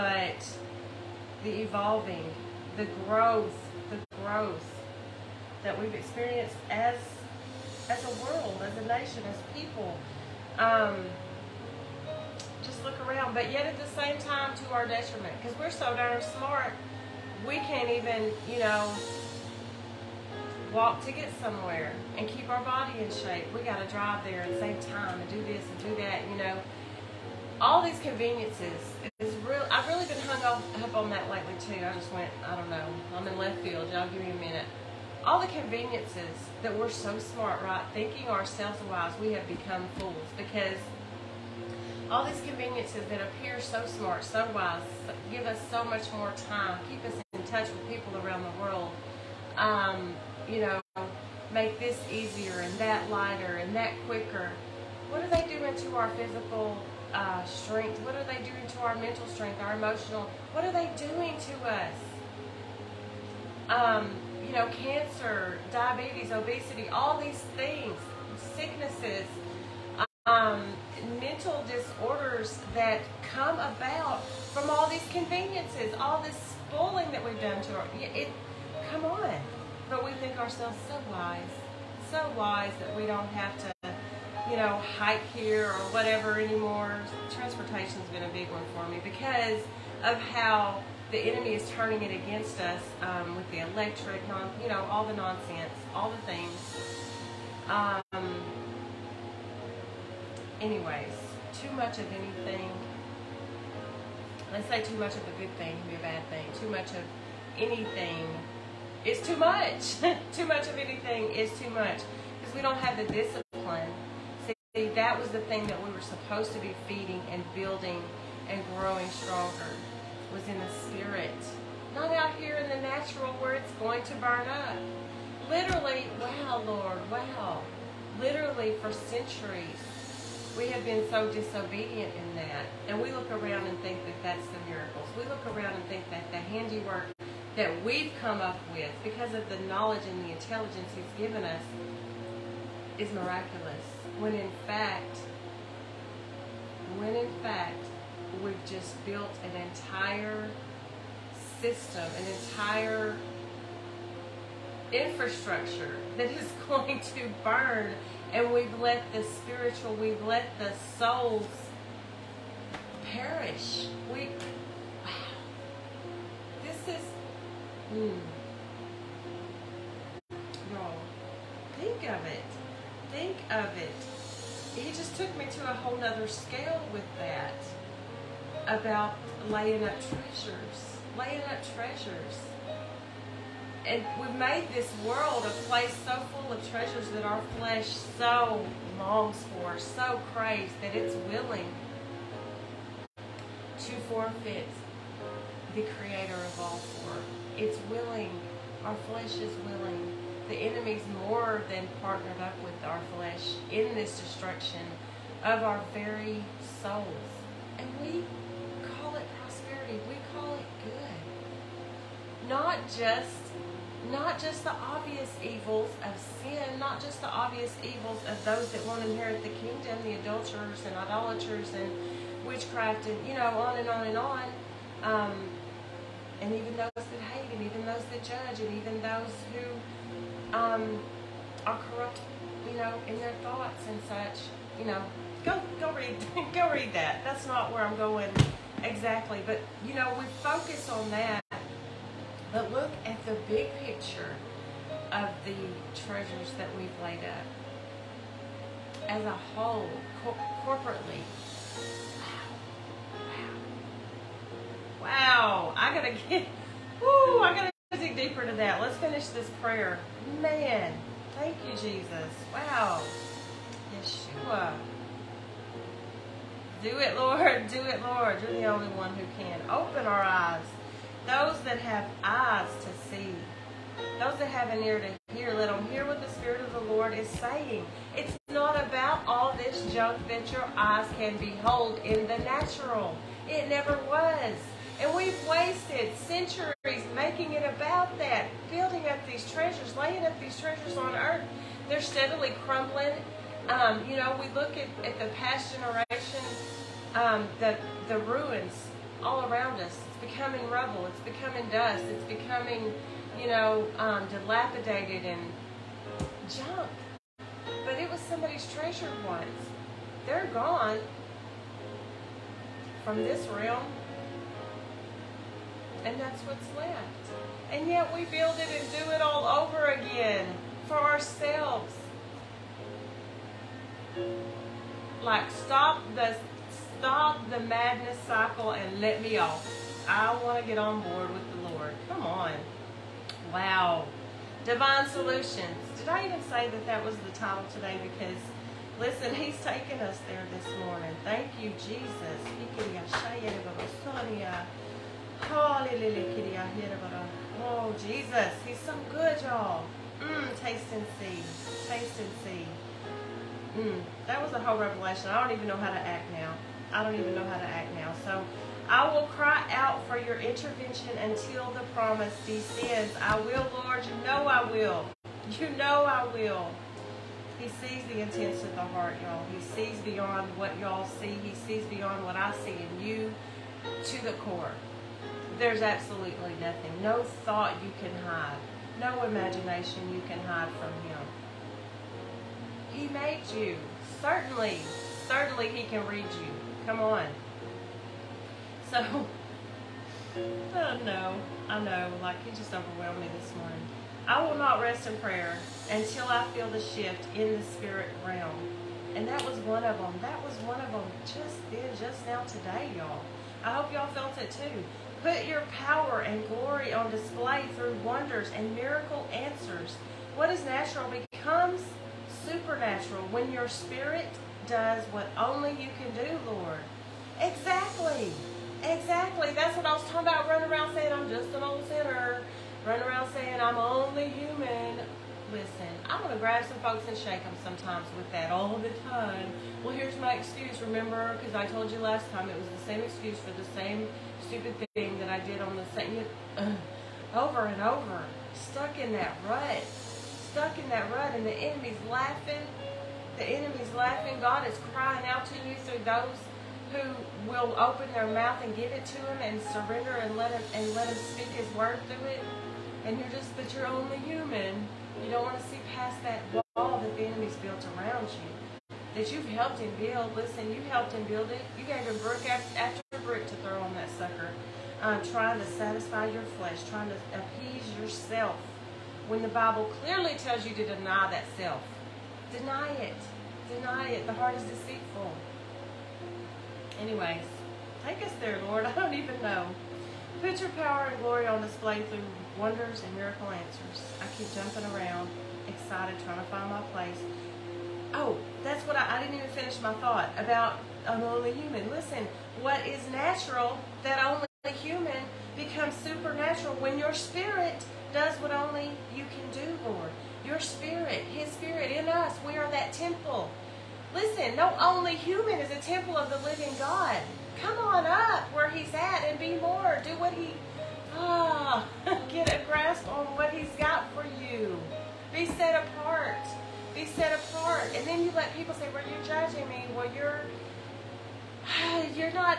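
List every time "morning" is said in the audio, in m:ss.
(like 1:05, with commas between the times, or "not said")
5:40, 6:33.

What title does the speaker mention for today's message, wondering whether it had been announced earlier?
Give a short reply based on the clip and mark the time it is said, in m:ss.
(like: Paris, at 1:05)
Divine Solutions, at 5:34.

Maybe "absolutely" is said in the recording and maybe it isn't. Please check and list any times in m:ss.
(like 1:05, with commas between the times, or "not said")
6:15.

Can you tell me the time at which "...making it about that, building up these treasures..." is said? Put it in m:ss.
4:47.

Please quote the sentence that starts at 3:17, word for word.
It's willing, our flesh is willing.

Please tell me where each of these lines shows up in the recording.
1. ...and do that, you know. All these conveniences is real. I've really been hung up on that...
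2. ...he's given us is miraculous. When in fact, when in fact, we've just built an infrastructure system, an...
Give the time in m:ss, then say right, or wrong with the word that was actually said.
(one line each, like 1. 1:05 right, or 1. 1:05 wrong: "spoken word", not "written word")
1. 0:25 right
2. 2:20 wrong: "entire", not "infrastructure".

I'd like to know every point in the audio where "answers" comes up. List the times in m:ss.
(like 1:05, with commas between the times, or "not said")
6:49, 8:03.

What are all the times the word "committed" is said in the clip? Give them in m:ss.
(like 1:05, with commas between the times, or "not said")
not said.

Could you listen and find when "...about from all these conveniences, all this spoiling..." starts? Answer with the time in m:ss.
1:13.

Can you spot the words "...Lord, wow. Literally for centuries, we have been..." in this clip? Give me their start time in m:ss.
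2:06.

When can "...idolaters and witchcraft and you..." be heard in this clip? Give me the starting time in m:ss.
3:40.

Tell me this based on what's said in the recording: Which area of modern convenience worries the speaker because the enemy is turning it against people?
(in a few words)
Transportation.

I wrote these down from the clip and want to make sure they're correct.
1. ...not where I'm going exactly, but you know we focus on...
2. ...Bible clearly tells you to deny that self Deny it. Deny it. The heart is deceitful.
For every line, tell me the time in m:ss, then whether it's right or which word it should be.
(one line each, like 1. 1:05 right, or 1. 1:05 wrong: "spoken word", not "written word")
1. 3:57 right
2. 7:49 right.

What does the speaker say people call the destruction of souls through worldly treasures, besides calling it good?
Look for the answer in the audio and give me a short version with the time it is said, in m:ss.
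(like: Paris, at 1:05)
prosperity, at 3:29.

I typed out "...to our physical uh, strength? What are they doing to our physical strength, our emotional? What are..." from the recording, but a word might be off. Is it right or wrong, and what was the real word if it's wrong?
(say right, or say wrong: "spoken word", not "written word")
wrong: "mental", not "physical".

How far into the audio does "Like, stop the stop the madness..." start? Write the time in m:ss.
5:25.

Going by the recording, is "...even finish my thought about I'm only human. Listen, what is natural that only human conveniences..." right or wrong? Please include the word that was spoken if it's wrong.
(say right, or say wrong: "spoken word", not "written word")
wrong: "becomes", not "conveniences".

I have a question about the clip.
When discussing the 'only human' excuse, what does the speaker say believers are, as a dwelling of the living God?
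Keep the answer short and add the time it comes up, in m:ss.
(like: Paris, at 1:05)
a temple, at 8:25.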